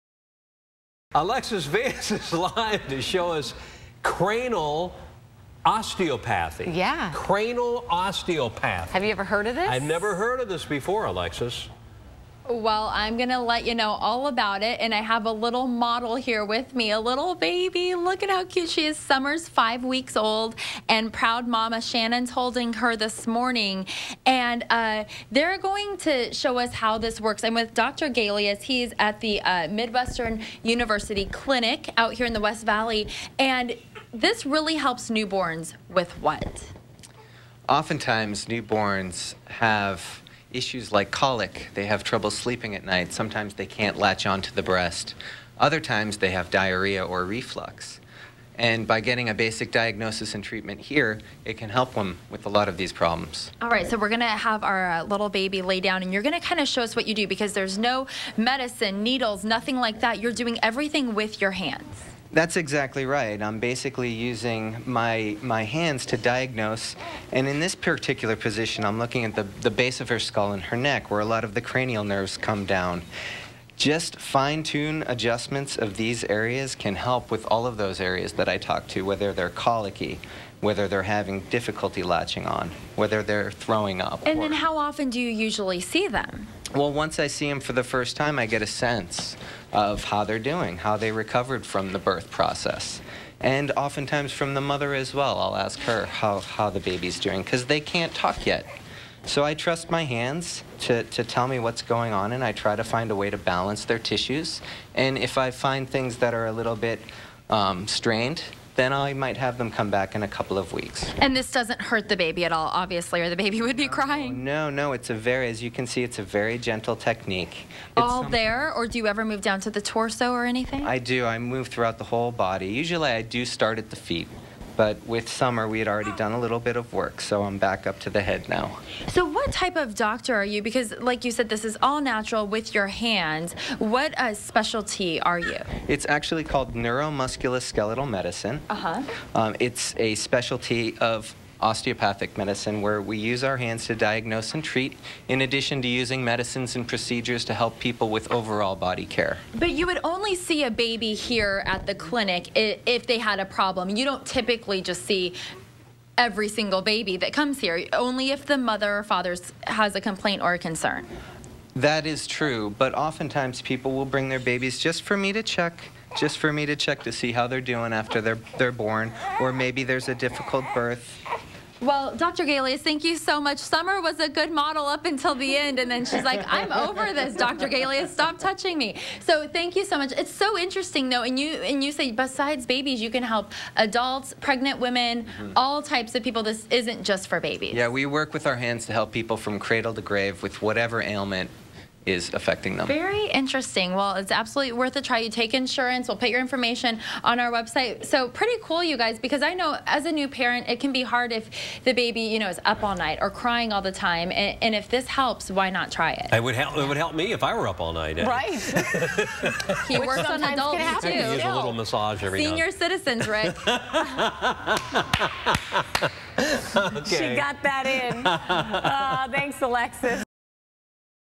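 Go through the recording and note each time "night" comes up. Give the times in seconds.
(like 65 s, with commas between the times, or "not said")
42 s, 202 s, 207 s.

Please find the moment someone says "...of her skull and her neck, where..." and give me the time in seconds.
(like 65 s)
69 s.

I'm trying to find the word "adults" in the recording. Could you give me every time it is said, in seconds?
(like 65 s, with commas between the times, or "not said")
183 s, 210 s.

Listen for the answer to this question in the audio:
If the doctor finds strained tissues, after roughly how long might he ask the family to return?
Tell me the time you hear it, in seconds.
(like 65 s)
110 s.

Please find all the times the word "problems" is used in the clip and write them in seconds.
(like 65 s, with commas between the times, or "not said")
52 s, 153 s.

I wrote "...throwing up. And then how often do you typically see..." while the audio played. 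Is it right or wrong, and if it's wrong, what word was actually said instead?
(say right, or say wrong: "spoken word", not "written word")
wrong: "usually", not "typically".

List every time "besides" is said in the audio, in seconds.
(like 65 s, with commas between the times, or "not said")
182 s.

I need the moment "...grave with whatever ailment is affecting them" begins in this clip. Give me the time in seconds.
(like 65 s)
190 s.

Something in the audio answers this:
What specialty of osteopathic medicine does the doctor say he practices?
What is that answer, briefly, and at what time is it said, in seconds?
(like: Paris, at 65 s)
Neuromusculoskeletal medicine, at 136 s.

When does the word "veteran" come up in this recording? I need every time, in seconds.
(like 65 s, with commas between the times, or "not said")
not said.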